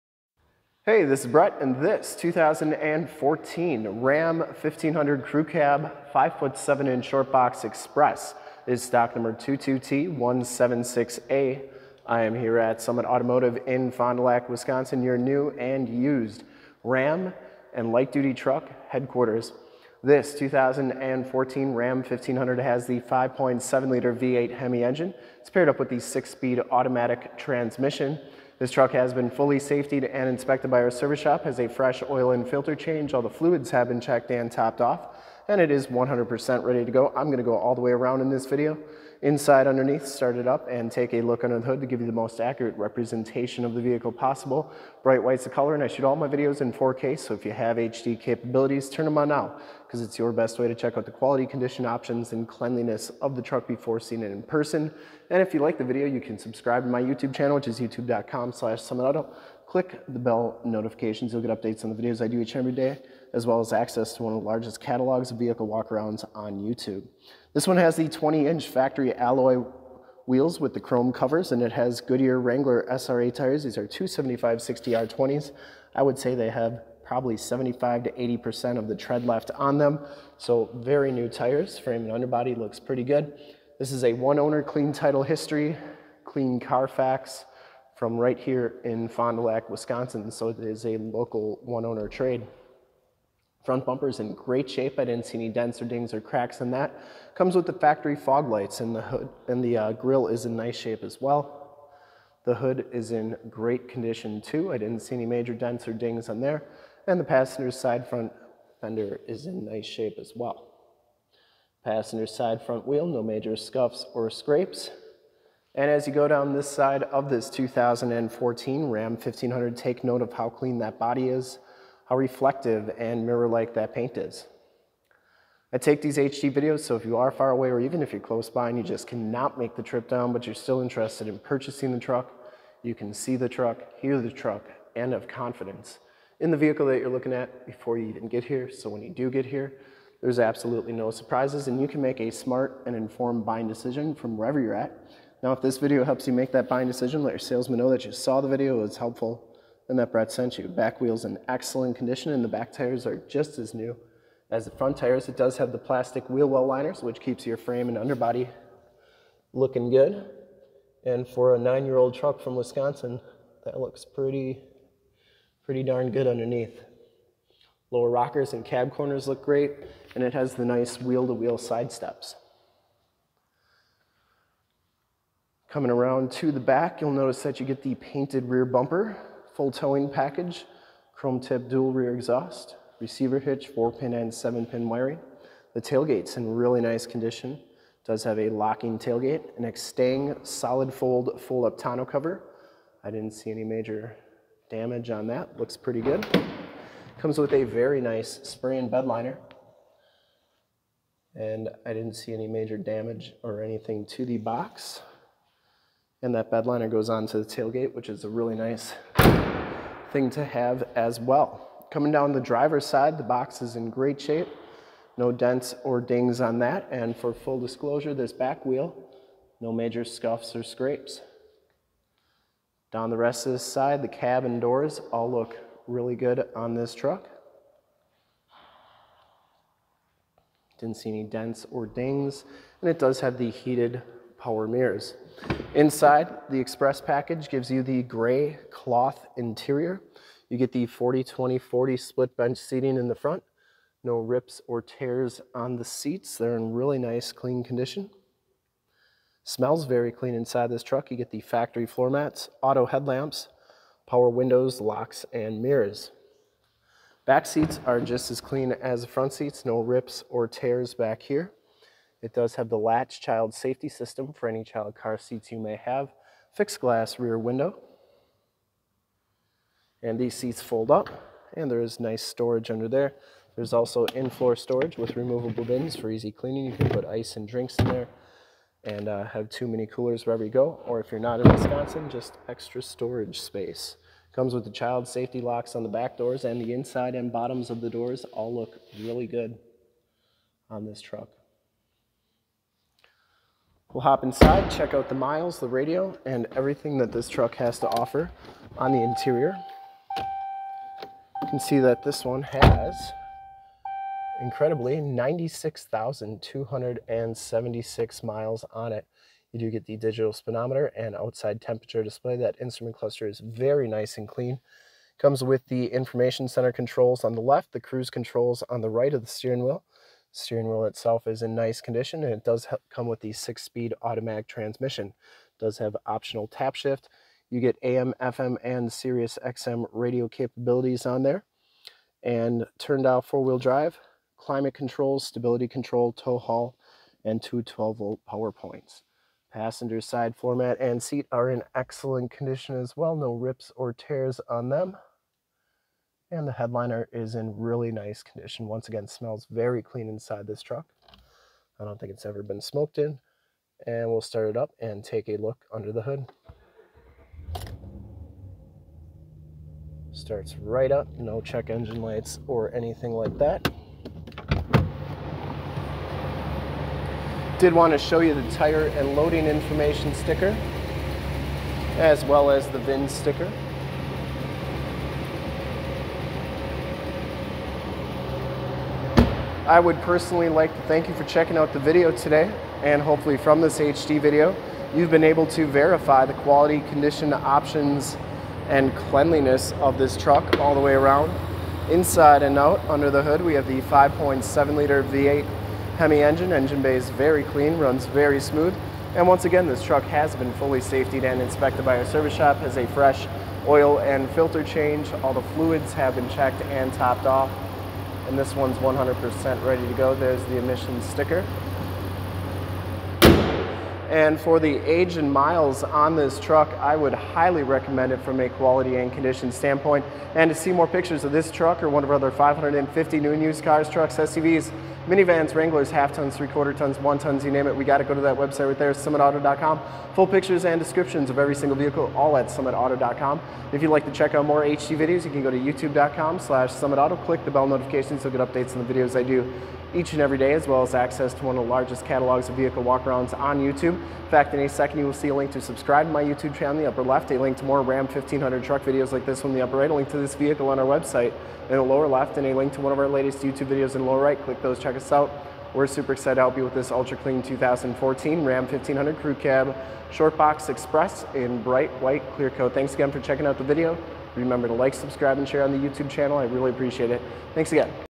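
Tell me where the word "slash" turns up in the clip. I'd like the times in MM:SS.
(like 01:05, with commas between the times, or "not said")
00:58, 07:16.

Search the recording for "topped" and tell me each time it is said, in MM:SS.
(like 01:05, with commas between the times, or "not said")
00:34, 06:46.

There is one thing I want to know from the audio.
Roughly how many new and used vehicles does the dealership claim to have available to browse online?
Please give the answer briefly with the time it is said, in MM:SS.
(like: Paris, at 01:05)
550, at 07:02.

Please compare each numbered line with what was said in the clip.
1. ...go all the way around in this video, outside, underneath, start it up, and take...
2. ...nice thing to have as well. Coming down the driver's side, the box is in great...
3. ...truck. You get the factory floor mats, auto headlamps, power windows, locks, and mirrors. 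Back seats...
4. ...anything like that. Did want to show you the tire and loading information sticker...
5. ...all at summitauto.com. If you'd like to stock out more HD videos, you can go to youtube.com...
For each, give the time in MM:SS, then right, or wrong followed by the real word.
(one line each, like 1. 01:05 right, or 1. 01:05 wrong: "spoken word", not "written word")
1. 00:37 wrong: "inside", not "outside"
2. 03:28 right
3. 04:10 right
4. 06:02 right
5. 07:12 wrong: "check", not "stock".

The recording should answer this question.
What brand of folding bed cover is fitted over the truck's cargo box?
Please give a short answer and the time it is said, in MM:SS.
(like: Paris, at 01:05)
Extang, at 03:09.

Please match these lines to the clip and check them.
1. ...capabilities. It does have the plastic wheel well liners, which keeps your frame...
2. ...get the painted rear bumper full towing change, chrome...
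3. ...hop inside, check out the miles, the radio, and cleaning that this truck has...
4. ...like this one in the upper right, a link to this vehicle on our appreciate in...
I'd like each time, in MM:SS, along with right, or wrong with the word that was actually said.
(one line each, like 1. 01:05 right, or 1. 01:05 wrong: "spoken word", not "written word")
1. 02:34 wrong: "tires", not "capabilities"
2. 02:57 wrong: "package", not "change"
3. 04:54 wrong: "everything", not "cleaning"
4. 07:29 wrong: "website", not "appreciate".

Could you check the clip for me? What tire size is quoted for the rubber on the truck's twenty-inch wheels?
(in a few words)
275 60R20.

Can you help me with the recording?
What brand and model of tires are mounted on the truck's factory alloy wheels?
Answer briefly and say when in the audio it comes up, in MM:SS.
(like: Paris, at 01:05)
Goodyear Wrangler SRA, at 01:12.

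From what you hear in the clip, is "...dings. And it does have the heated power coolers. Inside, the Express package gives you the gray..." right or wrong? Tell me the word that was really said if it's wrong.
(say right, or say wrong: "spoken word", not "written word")
wrong: "mirrors", not "coolers".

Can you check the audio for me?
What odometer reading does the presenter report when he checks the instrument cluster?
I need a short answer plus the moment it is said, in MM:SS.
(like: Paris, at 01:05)
96,276 miles, at 05:05.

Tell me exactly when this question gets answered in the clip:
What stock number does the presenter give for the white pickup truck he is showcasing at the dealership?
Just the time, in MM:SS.
00:09.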